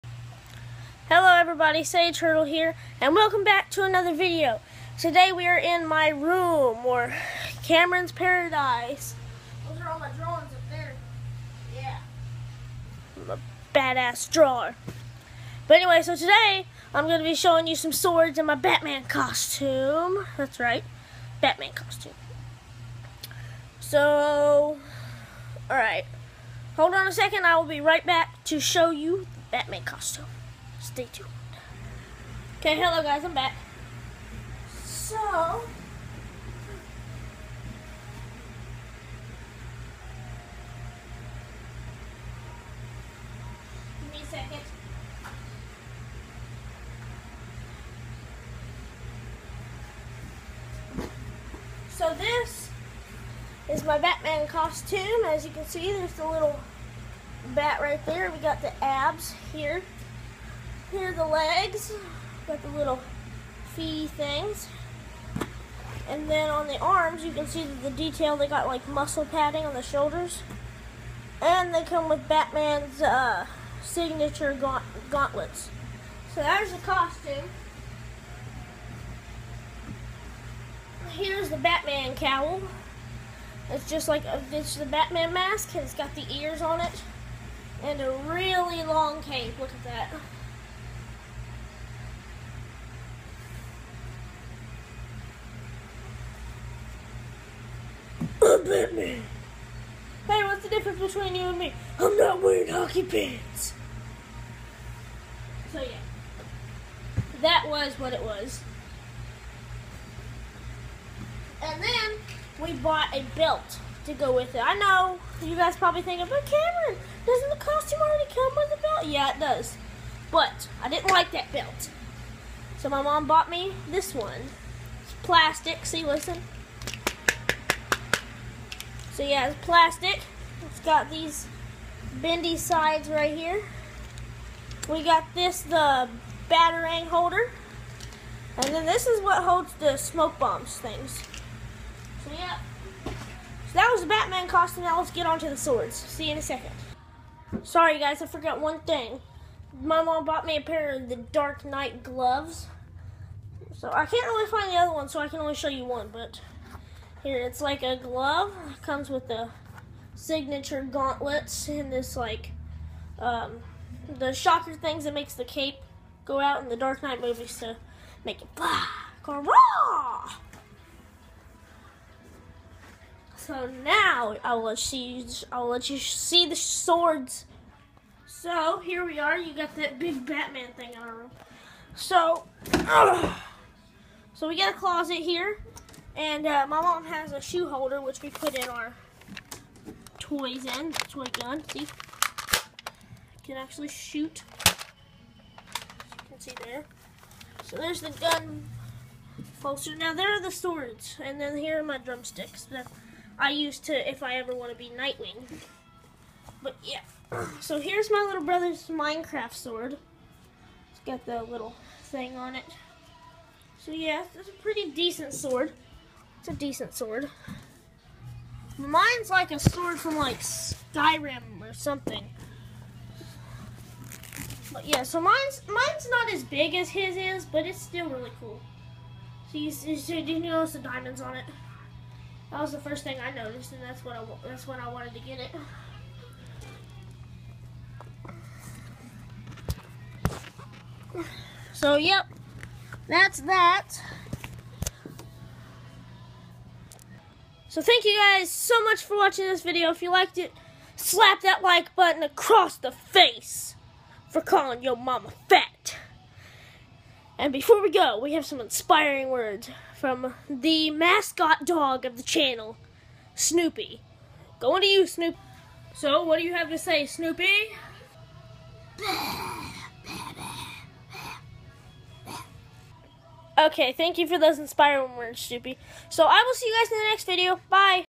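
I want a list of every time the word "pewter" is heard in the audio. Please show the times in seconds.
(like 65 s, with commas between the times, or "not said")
not said.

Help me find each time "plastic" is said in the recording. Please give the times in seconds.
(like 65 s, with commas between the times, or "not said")
125 s, 129 s.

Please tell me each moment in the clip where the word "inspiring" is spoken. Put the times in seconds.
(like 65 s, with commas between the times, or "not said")
258 s, 274 s.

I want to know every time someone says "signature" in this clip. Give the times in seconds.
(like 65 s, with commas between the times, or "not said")
73 s, 160 s.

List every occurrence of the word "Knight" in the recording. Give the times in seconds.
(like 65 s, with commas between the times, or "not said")
151 s, 167 s.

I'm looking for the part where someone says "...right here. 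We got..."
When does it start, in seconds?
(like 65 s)
133 s.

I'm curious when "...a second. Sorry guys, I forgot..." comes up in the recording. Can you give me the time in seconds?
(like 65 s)
146 s.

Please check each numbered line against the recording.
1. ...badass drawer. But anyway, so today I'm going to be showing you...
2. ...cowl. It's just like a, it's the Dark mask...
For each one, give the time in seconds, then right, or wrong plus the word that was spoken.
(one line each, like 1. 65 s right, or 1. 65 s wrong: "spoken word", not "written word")
1. 13 s right
2. 82 s wrong: "Batman", not "Dark".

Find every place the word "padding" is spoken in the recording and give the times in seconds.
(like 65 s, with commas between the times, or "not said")
69 s.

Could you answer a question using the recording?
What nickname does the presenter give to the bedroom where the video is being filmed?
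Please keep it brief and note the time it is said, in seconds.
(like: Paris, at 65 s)
Cameron's Paradise, at 7 s.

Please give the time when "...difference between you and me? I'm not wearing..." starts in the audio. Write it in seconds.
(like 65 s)
100 s.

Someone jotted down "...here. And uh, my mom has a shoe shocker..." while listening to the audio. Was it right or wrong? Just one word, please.
wrong.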